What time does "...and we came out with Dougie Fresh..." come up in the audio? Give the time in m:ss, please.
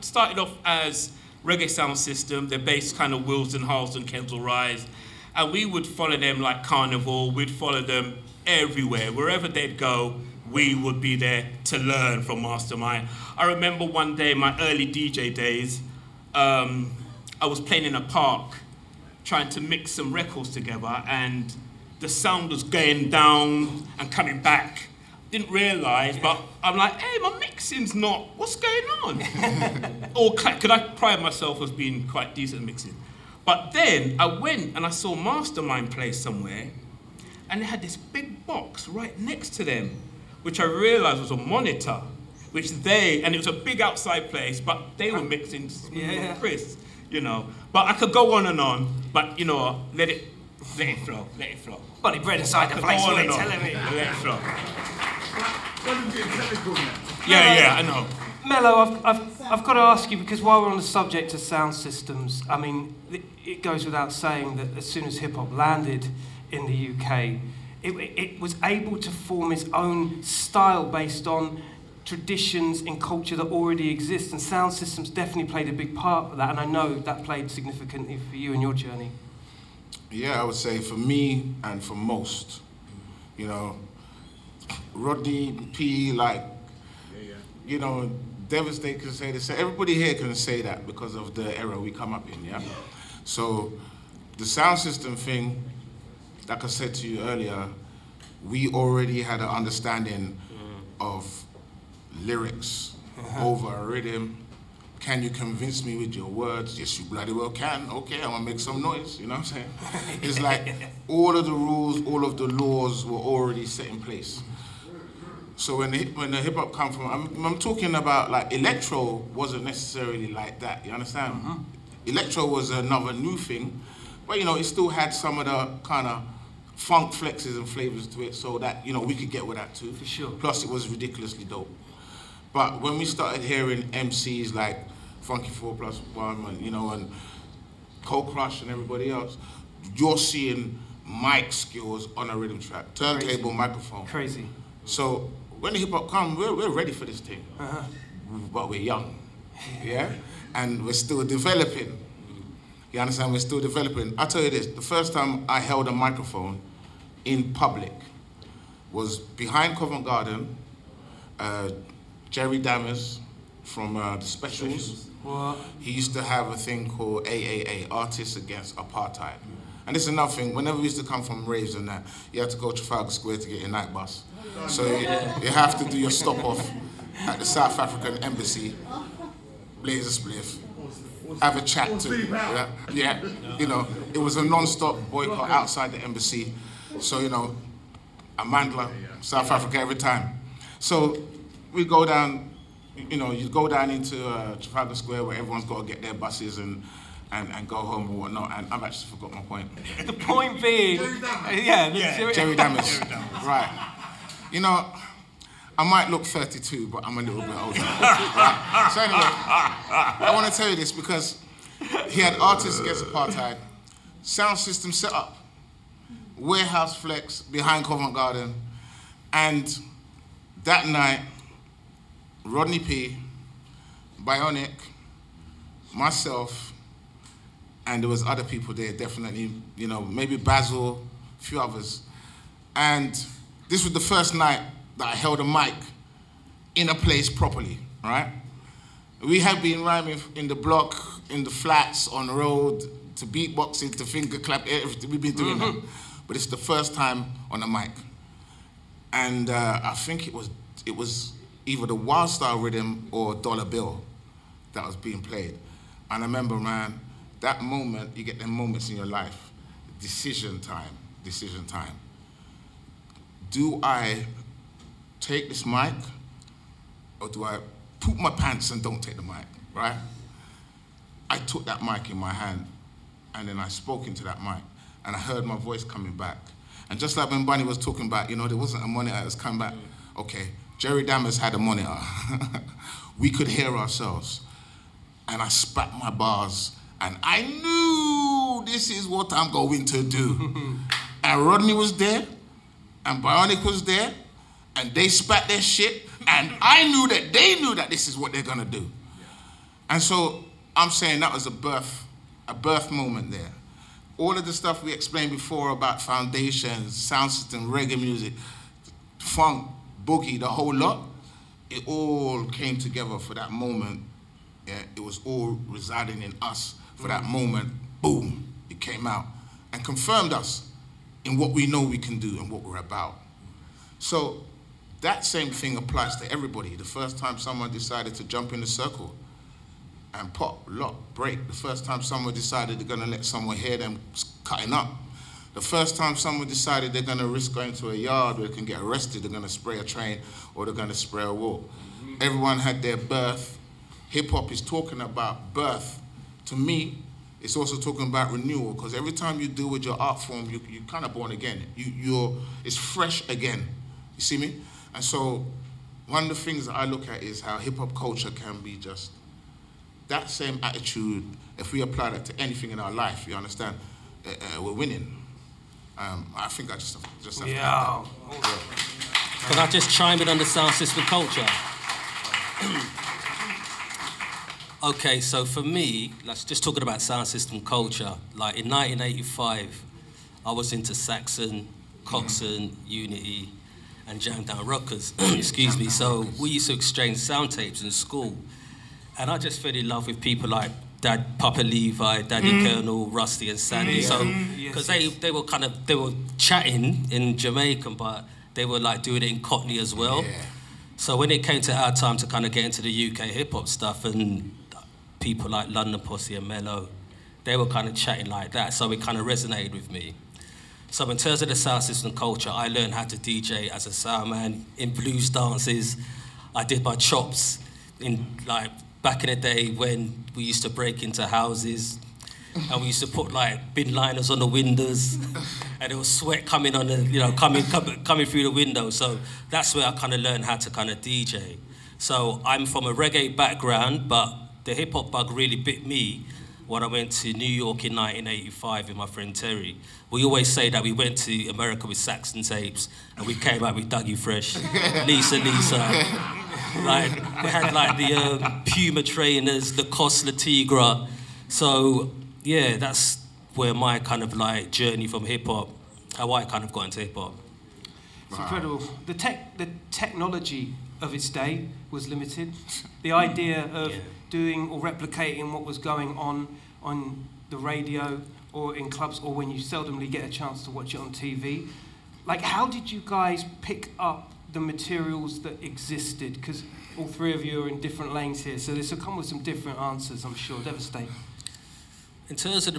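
7:23.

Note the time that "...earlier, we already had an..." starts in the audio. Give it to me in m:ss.
1:37.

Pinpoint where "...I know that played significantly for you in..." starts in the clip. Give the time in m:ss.
1:16.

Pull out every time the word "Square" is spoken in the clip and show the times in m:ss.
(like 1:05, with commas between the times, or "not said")
2:53, 3:14.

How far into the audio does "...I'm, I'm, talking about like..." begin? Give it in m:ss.
1:57.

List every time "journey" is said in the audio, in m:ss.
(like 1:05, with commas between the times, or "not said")
1:18, 7:34.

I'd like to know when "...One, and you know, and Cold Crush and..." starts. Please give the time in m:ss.
2:16.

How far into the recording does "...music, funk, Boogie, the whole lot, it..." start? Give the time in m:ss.
5:08.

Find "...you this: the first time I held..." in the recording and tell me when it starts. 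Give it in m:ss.
2:34.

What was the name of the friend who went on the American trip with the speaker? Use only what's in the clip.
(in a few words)
Terry.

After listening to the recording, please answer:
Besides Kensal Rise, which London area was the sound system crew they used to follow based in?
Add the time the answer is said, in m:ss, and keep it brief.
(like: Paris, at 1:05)
Willesden, at 0:03.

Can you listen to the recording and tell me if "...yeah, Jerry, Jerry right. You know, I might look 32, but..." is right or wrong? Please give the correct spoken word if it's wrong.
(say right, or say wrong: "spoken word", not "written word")
right.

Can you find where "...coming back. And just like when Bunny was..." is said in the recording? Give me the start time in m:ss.
4:35.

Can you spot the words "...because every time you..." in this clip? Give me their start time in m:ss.
5:48.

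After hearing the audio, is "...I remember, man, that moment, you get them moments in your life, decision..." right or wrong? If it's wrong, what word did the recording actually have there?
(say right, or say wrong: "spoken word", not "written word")
right.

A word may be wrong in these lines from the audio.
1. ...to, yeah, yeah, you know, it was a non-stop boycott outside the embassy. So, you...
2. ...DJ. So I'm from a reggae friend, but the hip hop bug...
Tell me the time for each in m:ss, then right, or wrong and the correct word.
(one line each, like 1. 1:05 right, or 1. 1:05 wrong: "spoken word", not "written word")
1. 3:02 right
2. 7:11 wrong: "background", not "friend".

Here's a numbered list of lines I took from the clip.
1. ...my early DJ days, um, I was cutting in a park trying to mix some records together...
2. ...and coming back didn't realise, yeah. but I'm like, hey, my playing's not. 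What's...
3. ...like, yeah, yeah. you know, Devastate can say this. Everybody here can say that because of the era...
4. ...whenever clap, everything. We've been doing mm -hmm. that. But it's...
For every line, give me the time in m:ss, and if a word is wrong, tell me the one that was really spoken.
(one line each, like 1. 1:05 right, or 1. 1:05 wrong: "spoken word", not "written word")
1. 0:14 wrong: "playing", not "cutting"
2. 0:23 wrong: "mixing", not "playing"
3. 1:26 right
4. 4:04 wrong: "finger", not "whenever".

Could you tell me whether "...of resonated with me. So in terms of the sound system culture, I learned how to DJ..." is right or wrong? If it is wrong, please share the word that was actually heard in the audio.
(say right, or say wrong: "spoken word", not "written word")
right.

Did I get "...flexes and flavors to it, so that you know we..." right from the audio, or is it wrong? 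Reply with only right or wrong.
right.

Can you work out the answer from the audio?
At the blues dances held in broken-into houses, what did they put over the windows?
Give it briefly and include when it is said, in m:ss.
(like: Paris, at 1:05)
Bin liners, at 7:03.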